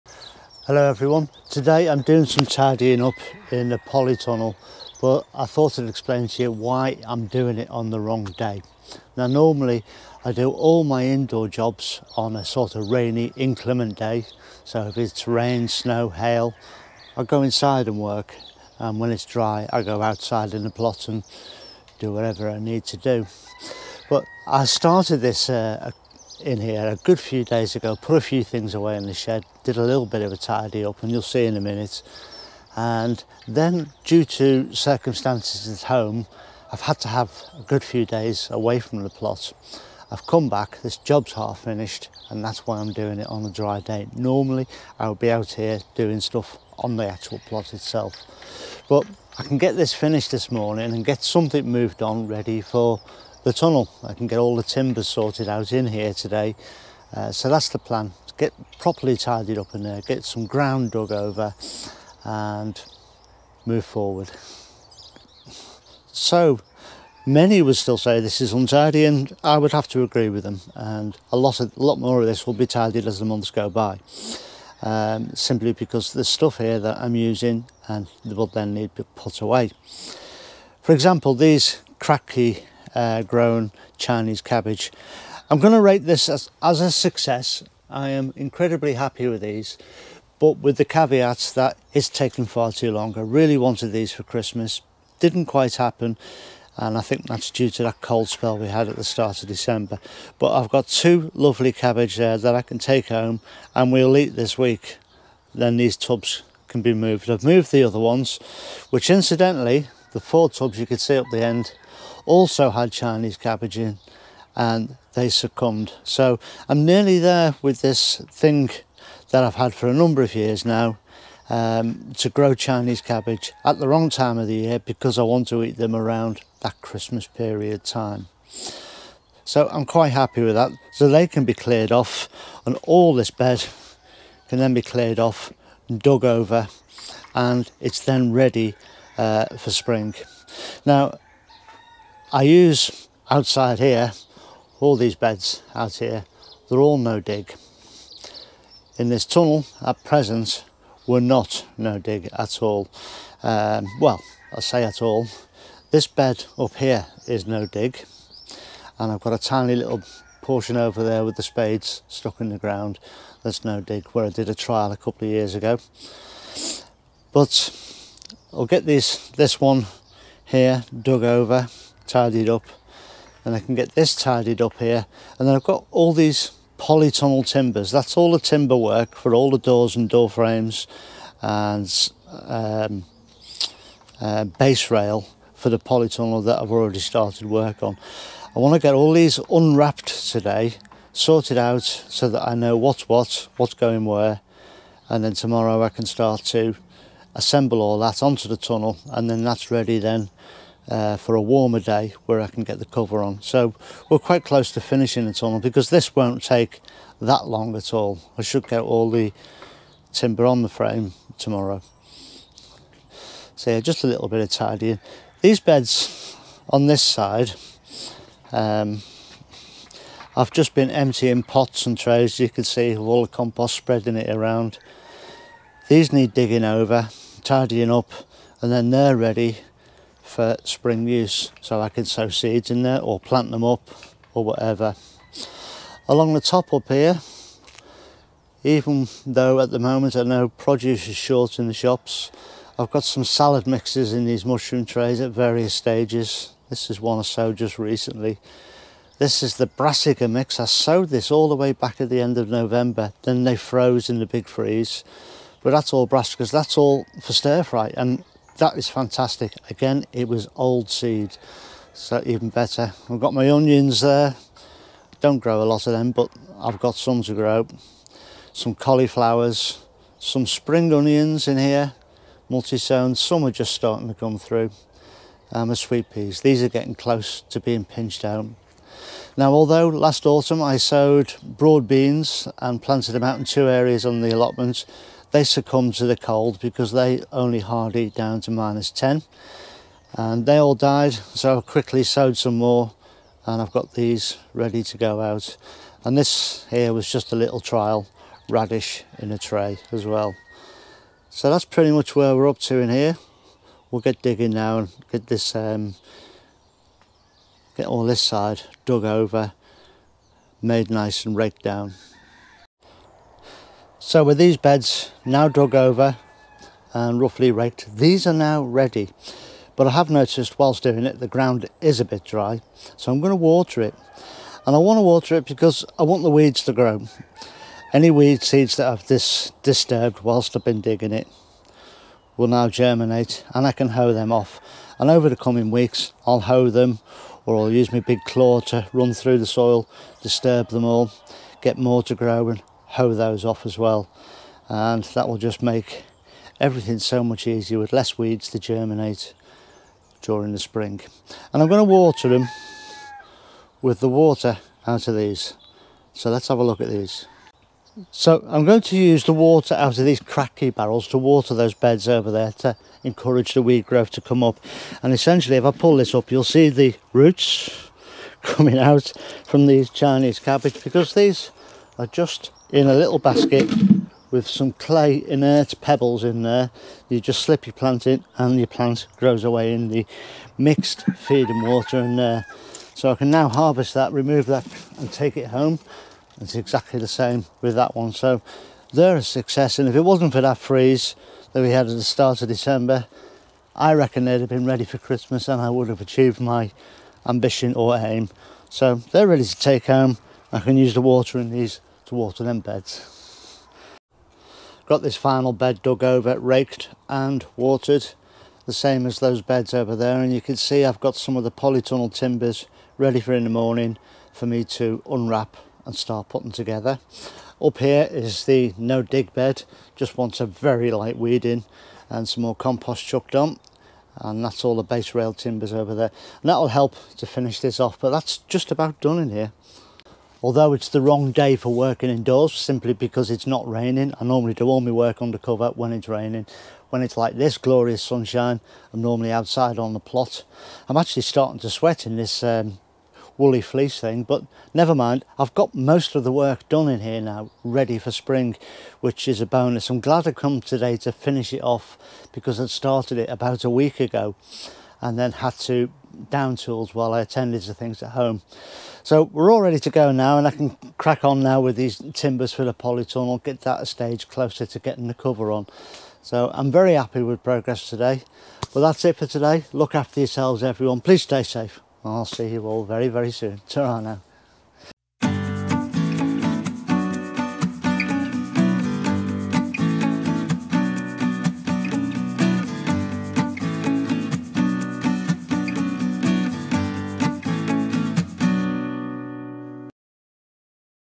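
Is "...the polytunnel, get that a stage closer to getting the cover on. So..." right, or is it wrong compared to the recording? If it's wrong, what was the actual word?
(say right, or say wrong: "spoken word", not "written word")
right.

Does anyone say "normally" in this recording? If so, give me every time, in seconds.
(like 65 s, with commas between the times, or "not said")
9 s, 44 s, 434 s, 439 s.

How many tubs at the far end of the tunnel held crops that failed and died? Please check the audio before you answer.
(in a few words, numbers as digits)
4.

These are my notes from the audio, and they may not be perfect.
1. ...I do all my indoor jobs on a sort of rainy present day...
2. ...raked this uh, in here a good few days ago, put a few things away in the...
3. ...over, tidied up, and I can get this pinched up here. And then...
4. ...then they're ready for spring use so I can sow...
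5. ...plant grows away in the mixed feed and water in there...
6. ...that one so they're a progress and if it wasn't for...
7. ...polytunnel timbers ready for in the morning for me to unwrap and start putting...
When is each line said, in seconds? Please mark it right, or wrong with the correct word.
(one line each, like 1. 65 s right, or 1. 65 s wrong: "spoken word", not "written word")
1. 10 s wrong: "inclement", not "present"
2. 24 s wrong: "started", not "raked"
3. 171 s wrong: "tidied", not "pinched"
4. 228 s right
5. 378 s right
6. 387 s wrong: "success", not "progress"
7. 411 s right.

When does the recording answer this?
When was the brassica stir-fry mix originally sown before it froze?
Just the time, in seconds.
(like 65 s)
252 s.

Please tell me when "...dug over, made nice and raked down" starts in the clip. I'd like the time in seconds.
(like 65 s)
308 s.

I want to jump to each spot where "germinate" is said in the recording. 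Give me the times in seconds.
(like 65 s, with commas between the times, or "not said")
332 s, 348 s.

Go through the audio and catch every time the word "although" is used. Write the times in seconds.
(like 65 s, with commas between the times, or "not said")
279 s, 430 s.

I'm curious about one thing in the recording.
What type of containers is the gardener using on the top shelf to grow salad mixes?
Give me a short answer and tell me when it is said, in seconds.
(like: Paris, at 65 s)
mushroom trays, at 244 s.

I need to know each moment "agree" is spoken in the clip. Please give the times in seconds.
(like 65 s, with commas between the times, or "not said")
70 s.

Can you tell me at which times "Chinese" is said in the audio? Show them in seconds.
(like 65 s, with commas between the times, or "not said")
83 s, 112 s, 122 s, 369 s.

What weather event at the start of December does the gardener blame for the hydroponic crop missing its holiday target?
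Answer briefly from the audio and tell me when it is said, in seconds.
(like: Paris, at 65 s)
cold spell, at 97 s.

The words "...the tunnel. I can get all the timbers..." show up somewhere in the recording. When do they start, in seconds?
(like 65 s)
53 s.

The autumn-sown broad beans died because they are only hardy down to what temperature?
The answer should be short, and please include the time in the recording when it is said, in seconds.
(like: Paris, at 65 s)
minus 10, at 288 s.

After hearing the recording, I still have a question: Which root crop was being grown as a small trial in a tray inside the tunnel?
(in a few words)
radish.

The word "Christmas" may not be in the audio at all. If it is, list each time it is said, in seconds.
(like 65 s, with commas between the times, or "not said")
94 s, 126 s, 394 s.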